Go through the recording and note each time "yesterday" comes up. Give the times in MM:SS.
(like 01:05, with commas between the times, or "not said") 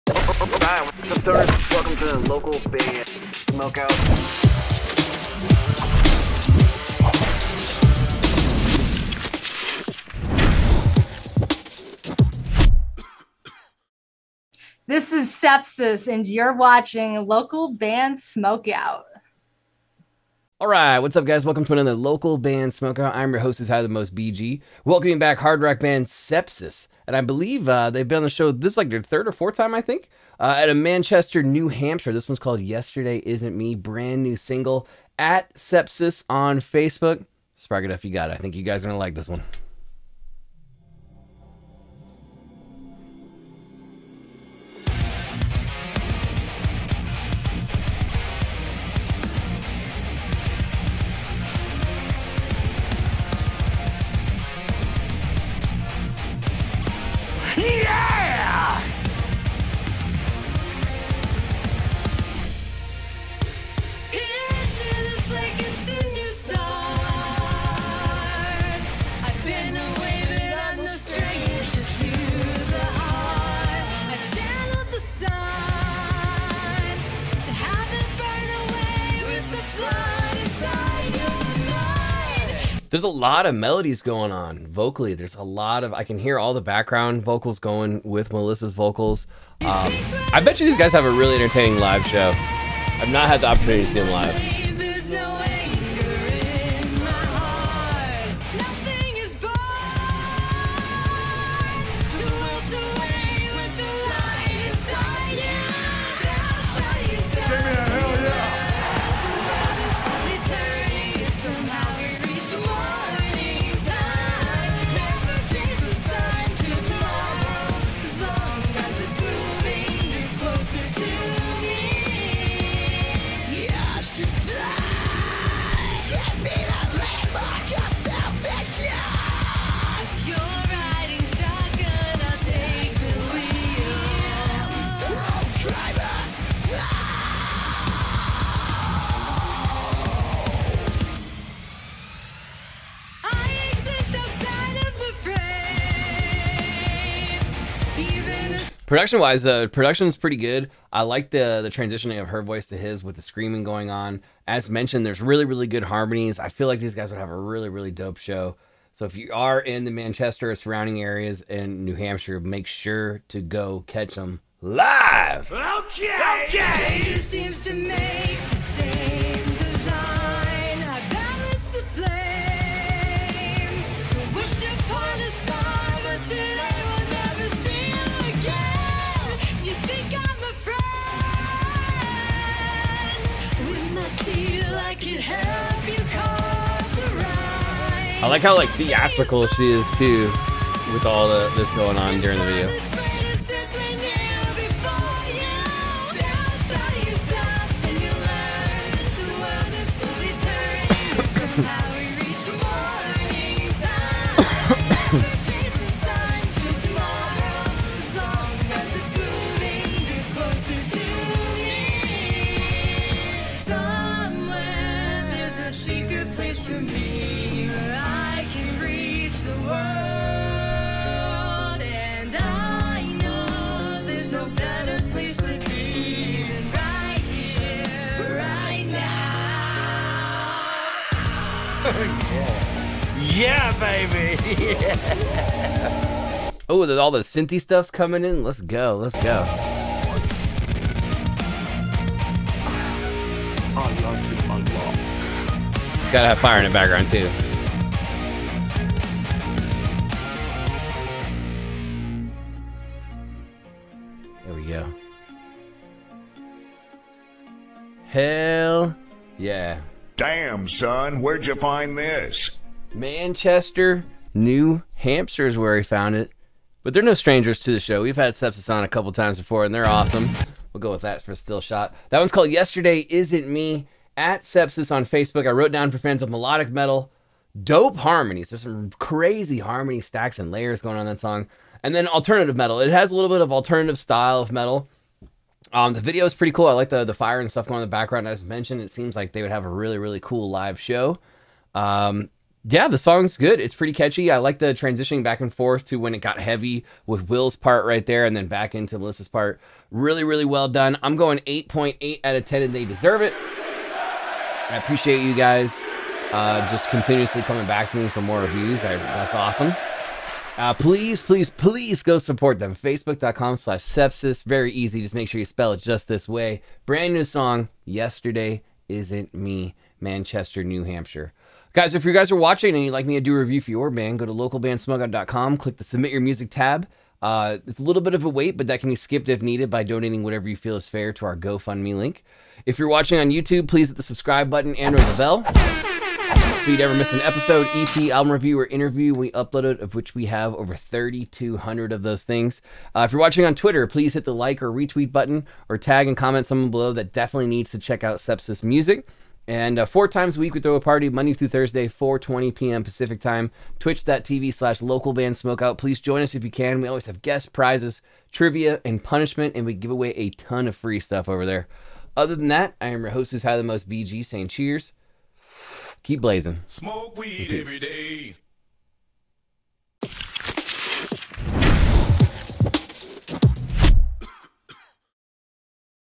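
00:32, 04:32, 05:17.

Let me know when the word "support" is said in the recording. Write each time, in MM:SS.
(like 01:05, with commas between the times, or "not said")
05:12.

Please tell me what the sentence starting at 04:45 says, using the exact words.
Um, the video is pretty cool.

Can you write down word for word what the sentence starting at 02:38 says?
So if you are in the Manchester or surrounding areas in New Hampshire, make sure to go catch them live.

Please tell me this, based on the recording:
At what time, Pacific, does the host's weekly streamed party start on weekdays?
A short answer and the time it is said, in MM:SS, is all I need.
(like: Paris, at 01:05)
4:20 p.m., at 05:51.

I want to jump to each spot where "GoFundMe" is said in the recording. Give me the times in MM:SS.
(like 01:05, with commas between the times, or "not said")
05:31.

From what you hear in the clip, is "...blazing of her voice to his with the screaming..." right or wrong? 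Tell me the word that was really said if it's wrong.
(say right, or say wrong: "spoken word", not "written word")
wrong: "transitioning", not "blazing".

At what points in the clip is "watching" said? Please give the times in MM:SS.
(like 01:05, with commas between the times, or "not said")
00:16, 05:22, 05:32, 05:43.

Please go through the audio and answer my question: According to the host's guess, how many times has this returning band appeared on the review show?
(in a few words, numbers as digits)
third or fourth.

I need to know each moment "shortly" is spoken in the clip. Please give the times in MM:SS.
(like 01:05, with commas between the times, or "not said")
not said.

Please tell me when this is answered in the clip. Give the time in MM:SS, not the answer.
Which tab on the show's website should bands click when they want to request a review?
05:25.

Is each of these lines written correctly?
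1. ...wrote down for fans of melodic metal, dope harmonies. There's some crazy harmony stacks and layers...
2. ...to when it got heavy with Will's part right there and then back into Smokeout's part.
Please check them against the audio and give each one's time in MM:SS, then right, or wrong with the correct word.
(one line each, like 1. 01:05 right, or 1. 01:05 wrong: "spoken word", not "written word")
1. 04:35 right
2. 04:55 wrong: "Melissa", not "Smokeout".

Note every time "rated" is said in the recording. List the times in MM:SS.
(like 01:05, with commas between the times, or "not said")
not said.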